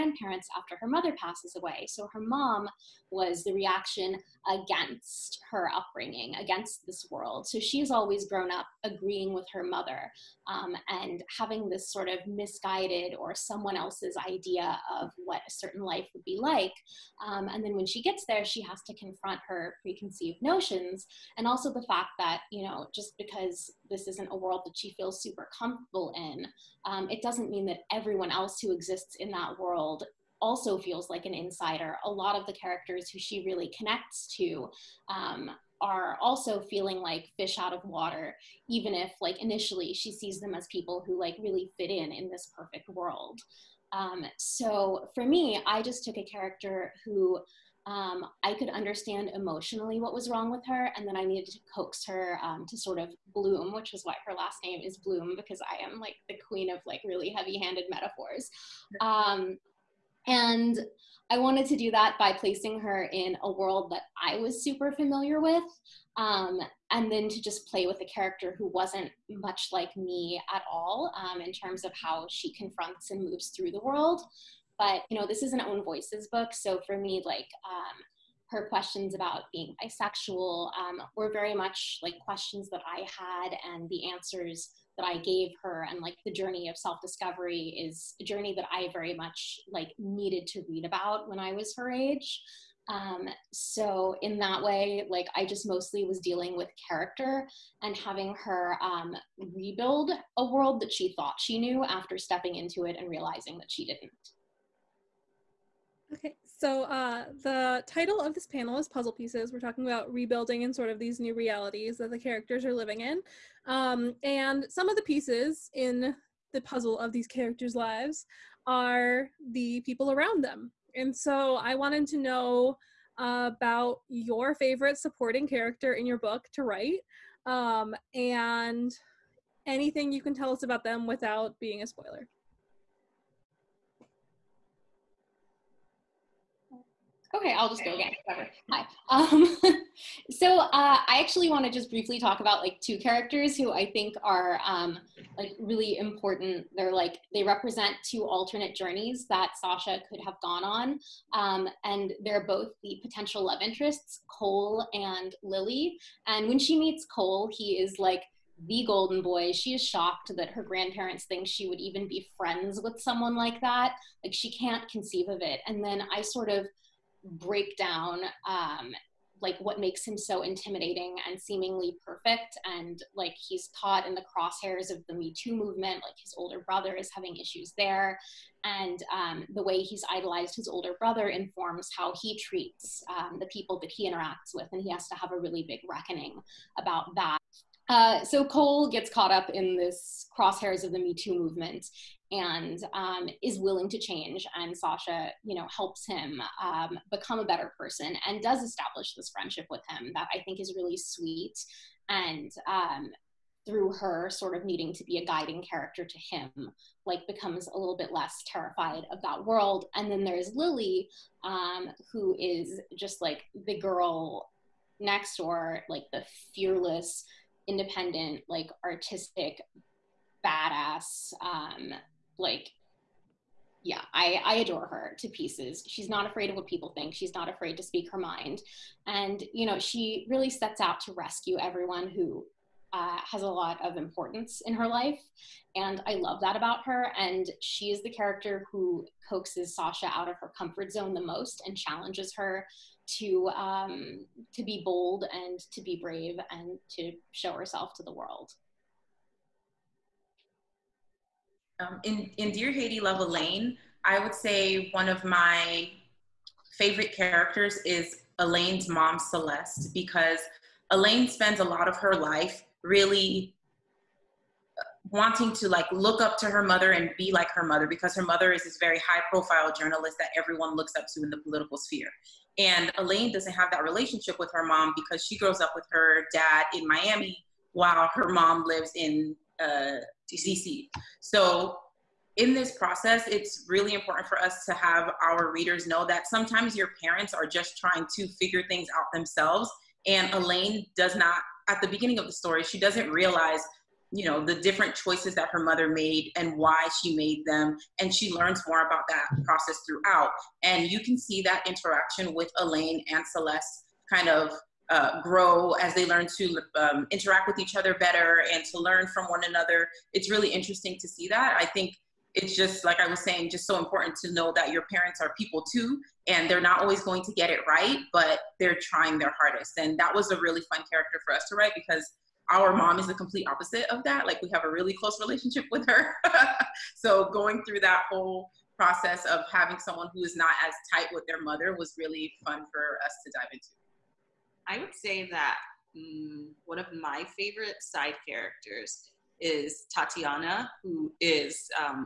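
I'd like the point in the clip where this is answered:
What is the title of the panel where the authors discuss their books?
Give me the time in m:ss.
1:48.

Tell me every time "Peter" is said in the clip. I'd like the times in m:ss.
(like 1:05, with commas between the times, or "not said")
not said.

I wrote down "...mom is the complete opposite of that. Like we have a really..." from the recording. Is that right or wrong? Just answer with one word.
right.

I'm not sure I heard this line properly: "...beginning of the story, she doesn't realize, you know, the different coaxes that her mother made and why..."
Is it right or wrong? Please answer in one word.
wrong.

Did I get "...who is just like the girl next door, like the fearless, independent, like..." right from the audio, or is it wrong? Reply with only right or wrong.
right.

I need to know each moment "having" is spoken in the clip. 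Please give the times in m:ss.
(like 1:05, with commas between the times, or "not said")
0:11, 1:37, 2:57, 5:29.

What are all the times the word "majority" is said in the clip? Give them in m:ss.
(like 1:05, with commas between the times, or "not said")
not said.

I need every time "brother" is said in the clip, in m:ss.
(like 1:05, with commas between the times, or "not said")
2:56, 3:00.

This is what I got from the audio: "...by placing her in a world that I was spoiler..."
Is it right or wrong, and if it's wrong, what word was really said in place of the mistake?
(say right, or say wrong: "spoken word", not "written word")
wrong: "super", not "spoiler".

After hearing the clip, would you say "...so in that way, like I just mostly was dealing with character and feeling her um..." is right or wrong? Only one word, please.
wrong.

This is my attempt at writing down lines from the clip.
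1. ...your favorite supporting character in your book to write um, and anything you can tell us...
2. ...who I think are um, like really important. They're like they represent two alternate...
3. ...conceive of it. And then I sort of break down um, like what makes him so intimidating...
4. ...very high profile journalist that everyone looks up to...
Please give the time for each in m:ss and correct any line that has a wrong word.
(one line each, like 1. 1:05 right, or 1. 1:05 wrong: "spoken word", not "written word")
1. 2:04 right
2. 2:23 right
3. 2:44 right
4. 4:28 right.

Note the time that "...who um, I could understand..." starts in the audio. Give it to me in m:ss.
0:47.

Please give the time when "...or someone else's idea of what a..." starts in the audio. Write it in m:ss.
0:13.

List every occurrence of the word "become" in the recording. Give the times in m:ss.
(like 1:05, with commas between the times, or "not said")
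3:17, 3:27.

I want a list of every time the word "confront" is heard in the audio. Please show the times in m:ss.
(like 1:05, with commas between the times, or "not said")
0:18, 1:12.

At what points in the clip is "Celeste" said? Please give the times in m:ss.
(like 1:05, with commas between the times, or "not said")
4:19, 5:03.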